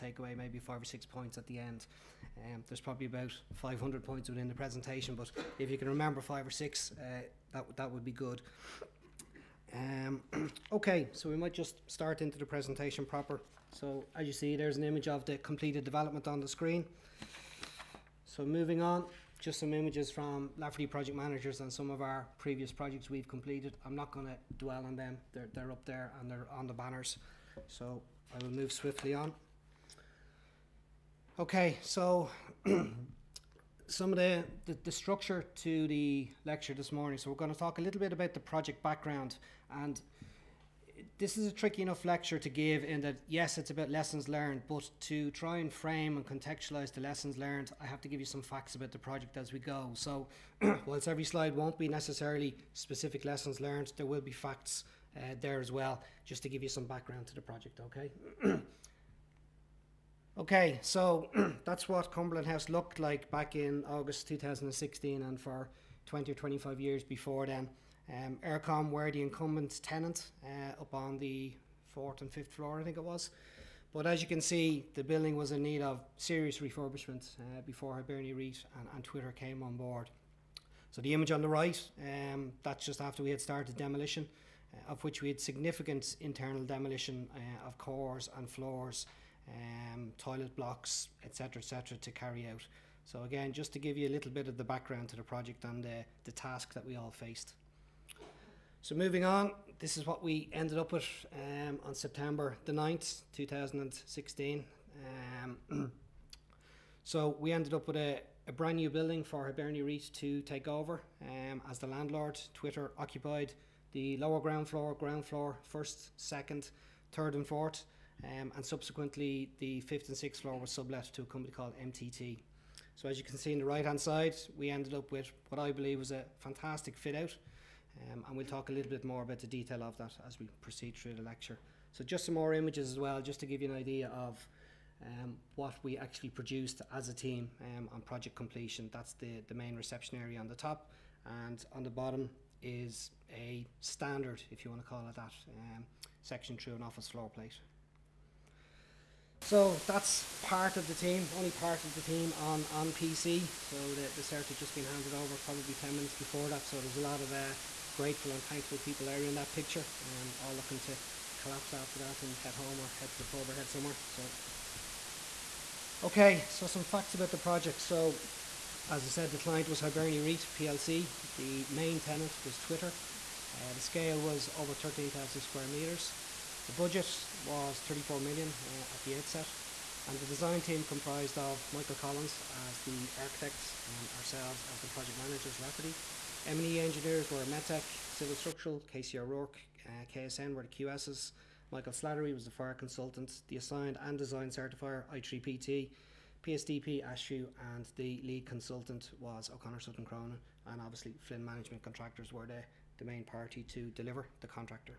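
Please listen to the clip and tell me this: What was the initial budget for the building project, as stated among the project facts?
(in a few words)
34 million.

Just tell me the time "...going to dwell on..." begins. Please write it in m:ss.
0:24.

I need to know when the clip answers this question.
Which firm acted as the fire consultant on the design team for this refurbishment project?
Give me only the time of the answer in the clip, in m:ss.
3:11.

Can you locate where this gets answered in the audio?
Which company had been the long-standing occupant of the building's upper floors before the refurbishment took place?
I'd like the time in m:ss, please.
1:08.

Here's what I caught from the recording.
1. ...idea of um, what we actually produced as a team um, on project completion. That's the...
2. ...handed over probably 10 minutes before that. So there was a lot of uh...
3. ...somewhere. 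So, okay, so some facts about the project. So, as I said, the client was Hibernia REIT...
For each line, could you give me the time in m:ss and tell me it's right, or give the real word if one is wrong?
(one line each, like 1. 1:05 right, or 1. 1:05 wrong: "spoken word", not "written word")
1. 2:13 right
2. 2:34 right
3. 2:43 right.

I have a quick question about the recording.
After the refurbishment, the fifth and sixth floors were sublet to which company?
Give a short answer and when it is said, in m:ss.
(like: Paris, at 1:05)
MTT, at 2:01.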